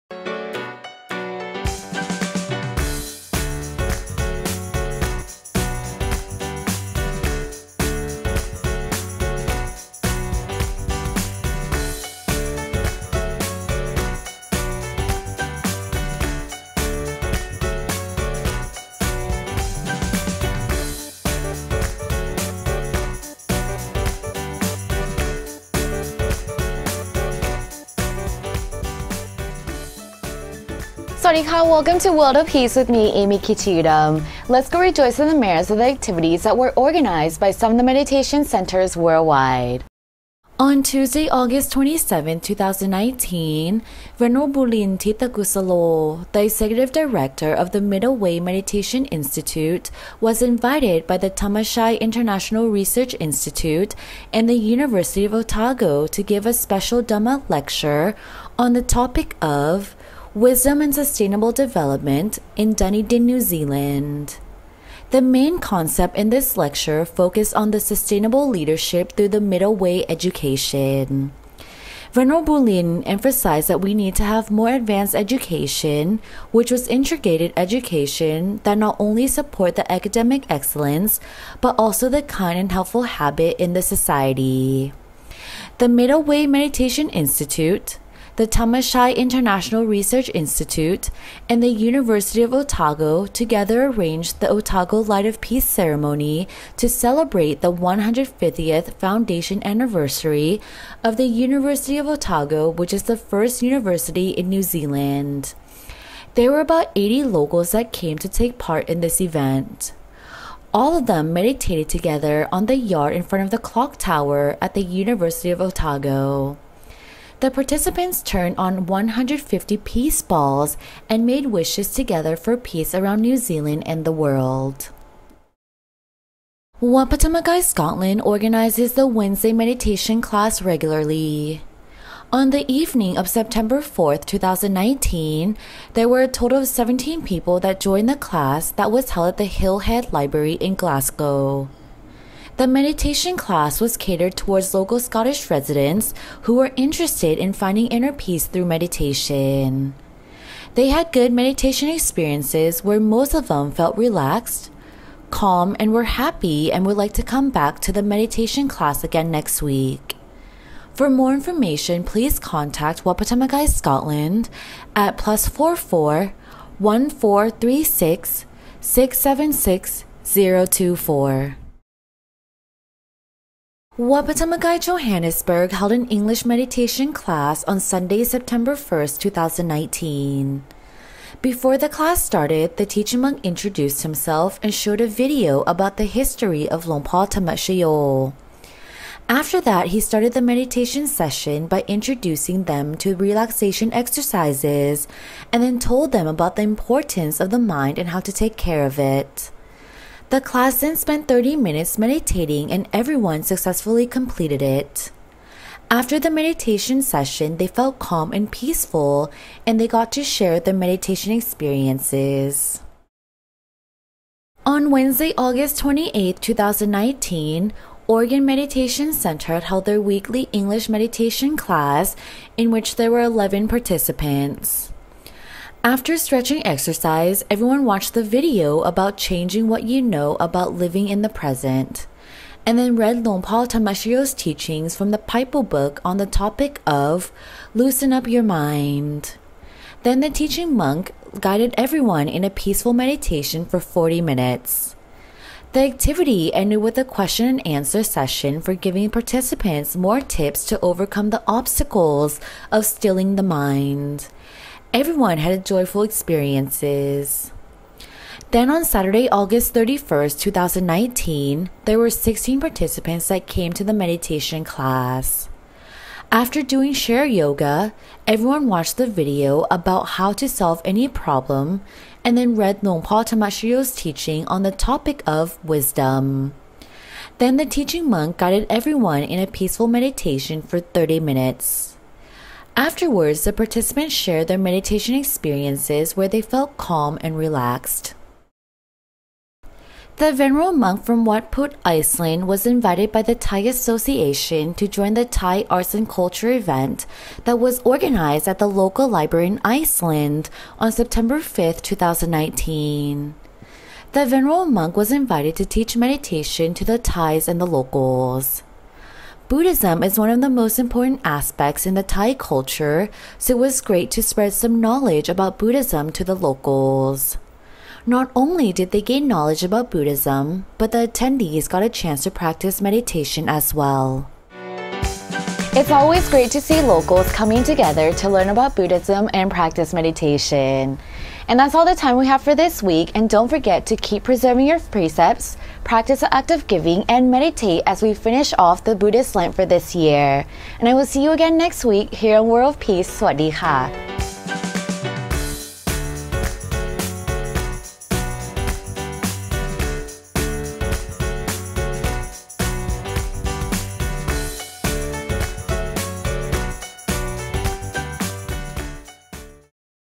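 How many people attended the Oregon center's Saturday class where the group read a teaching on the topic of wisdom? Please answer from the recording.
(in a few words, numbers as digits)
16.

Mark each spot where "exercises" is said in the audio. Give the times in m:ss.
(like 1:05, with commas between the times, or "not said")
3:13, 3:46.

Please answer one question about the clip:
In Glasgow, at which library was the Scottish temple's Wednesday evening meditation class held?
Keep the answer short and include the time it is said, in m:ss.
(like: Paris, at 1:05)
Hillhead Library, at 2:19.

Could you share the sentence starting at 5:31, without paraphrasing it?
And that's all the time we have for this week.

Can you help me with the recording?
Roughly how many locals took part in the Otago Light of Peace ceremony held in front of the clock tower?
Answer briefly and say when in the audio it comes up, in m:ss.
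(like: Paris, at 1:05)
80, at 1:46.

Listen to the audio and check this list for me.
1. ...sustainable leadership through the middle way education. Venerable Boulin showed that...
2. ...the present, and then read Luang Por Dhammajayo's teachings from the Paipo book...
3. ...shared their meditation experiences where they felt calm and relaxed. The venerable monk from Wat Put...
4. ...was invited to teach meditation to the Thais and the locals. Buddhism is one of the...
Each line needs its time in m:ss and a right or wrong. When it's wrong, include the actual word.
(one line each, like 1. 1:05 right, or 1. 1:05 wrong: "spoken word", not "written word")
1. 1:07 wrong: "emphasized", not "showed"
2. 3:51 right
3. 4:44 right
4. 5:04 right.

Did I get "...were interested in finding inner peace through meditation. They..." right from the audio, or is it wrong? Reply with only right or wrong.
right.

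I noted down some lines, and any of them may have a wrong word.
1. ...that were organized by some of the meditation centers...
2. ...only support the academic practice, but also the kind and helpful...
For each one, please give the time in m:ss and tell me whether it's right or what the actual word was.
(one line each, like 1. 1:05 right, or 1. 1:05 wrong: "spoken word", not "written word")
1. 0:36 right
2. 1:19 wrong: "excellence", not "practice".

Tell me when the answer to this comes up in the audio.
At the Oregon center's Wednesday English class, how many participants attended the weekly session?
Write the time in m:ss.
3:43.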